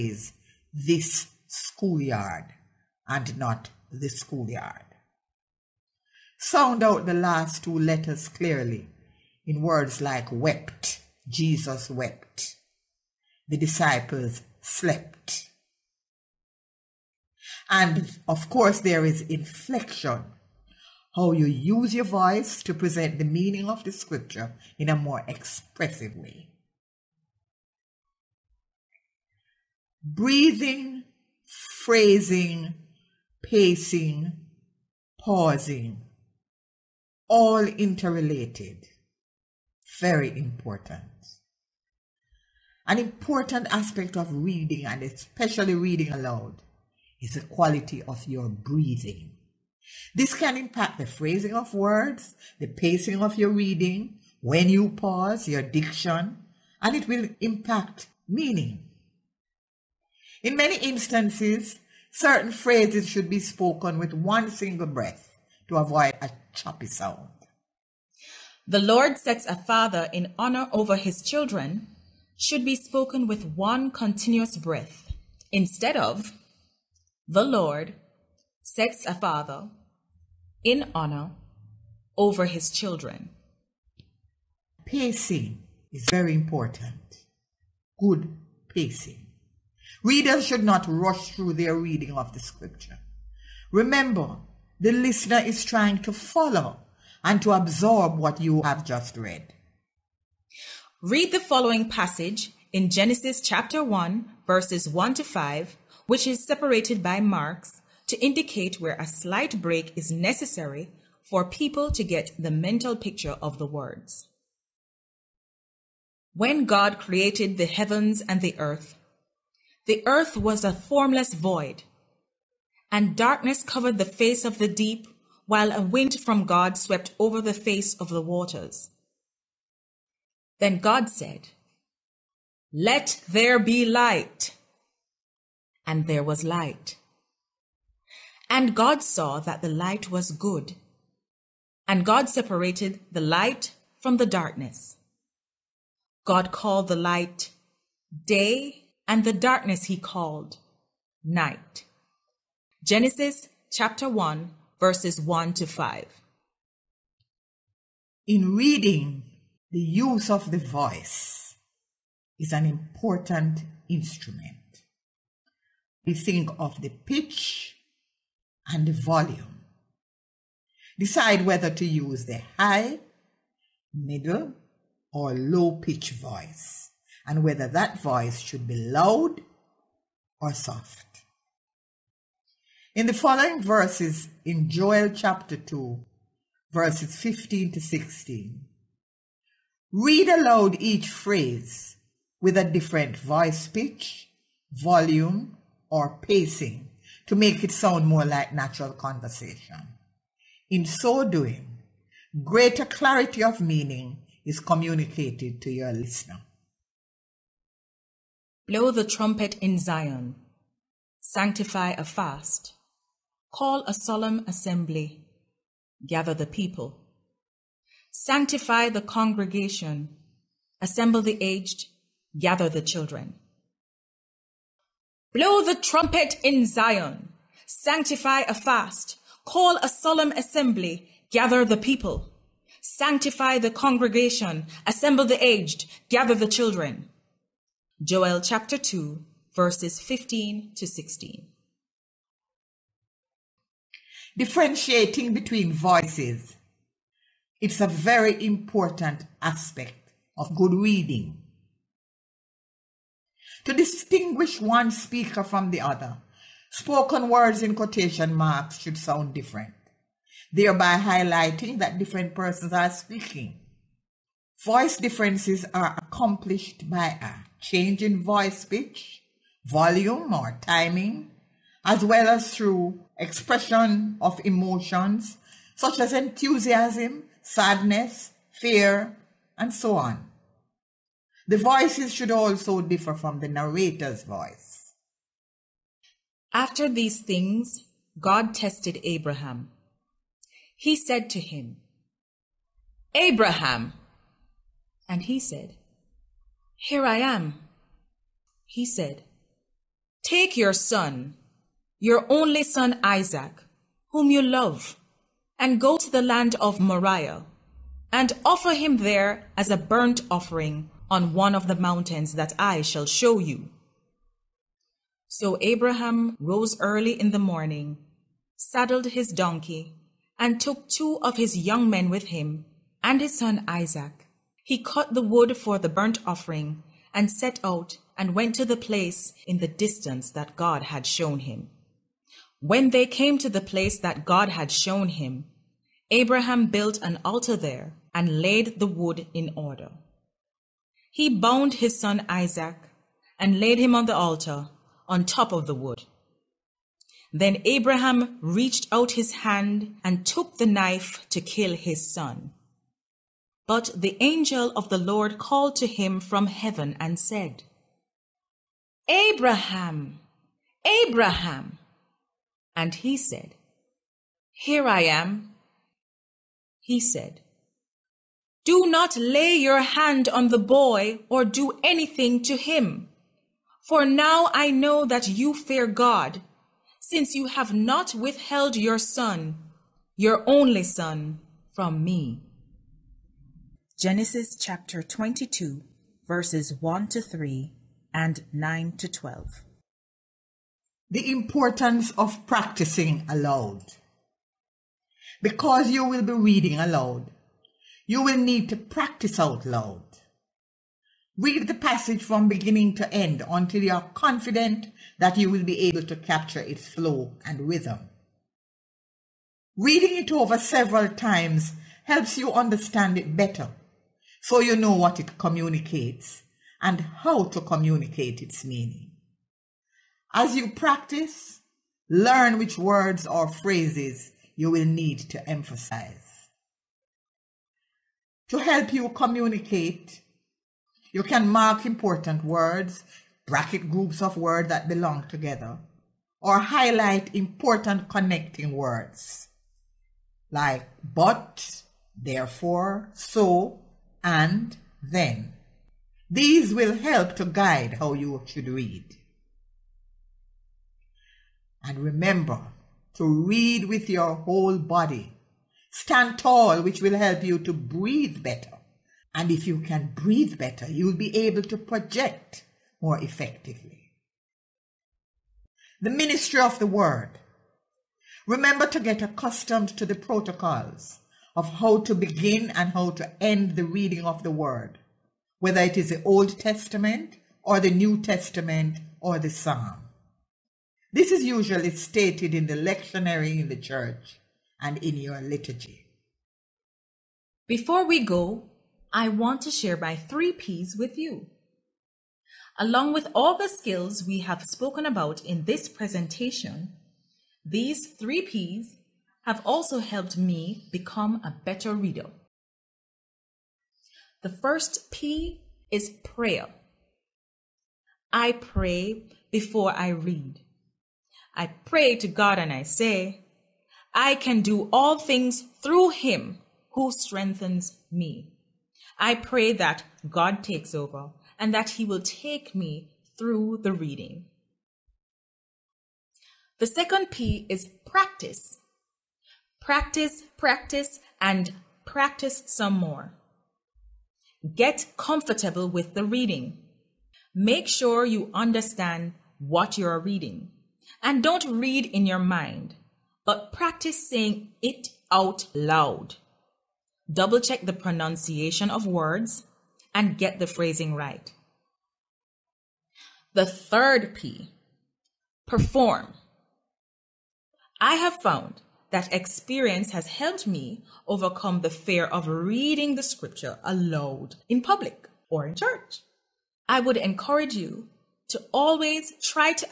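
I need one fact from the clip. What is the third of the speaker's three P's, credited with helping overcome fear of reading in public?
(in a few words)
perform.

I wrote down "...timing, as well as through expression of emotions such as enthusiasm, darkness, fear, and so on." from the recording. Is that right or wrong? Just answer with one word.
wrong.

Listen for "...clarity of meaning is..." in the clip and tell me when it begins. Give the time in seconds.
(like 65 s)
202 s.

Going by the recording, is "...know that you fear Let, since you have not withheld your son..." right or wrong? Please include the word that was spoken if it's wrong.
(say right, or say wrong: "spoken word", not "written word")
wrong: "God", not "Let".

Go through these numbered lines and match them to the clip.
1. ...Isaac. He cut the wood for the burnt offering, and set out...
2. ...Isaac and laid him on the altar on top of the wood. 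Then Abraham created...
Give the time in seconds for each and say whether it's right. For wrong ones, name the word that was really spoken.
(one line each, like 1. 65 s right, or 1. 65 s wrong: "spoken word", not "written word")
1. 323 s right
2. 342 s wrong: "reached", not "created".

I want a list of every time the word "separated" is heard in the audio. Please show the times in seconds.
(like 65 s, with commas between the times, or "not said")
106 s, 142 s.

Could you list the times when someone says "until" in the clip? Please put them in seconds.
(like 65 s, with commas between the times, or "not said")
403 s.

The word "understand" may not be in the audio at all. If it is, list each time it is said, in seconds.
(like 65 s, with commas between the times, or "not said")
412 s, 538 s.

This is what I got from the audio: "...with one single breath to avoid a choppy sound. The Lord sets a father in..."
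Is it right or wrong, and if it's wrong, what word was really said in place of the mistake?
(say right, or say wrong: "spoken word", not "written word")
right.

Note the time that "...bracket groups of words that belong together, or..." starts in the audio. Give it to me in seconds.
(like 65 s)
433 s.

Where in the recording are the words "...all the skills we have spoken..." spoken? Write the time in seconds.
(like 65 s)
493 s.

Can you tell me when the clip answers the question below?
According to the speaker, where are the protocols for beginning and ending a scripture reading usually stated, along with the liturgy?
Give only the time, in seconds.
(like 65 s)
482 s.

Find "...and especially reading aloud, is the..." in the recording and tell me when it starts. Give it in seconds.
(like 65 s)
44 s.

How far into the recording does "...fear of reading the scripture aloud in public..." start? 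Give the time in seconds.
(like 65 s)
561 s.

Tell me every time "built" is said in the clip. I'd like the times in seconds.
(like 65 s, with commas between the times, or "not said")
336 s.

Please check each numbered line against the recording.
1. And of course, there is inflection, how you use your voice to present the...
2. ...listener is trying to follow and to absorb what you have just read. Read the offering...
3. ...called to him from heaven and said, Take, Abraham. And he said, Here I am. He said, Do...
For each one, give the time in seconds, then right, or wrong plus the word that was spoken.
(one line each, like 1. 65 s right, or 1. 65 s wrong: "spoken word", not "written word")
1. 17 s right
2. 94 s wrong: "following", not "offering"
3. 355 s wrong: "Abraham", not "Take".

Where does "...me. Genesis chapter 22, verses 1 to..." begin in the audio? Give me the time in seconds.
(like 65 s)
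382 s.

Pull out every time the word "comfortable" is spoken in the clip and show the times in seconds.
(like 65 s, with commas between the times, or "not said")
535 s.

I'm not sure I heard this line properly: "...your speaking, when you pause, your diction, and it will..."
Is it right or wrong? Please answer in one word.
wrong.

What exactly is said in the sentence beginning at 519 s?
I pray that God takes over and that he will take me through the reading.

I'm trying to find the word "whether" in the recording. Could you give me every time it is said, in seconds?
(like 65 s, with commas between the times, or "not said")
171 s, 177 s, 475 s.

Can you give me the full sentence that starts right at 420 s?
As you practice, learn which words or phrases you will need to emphasize.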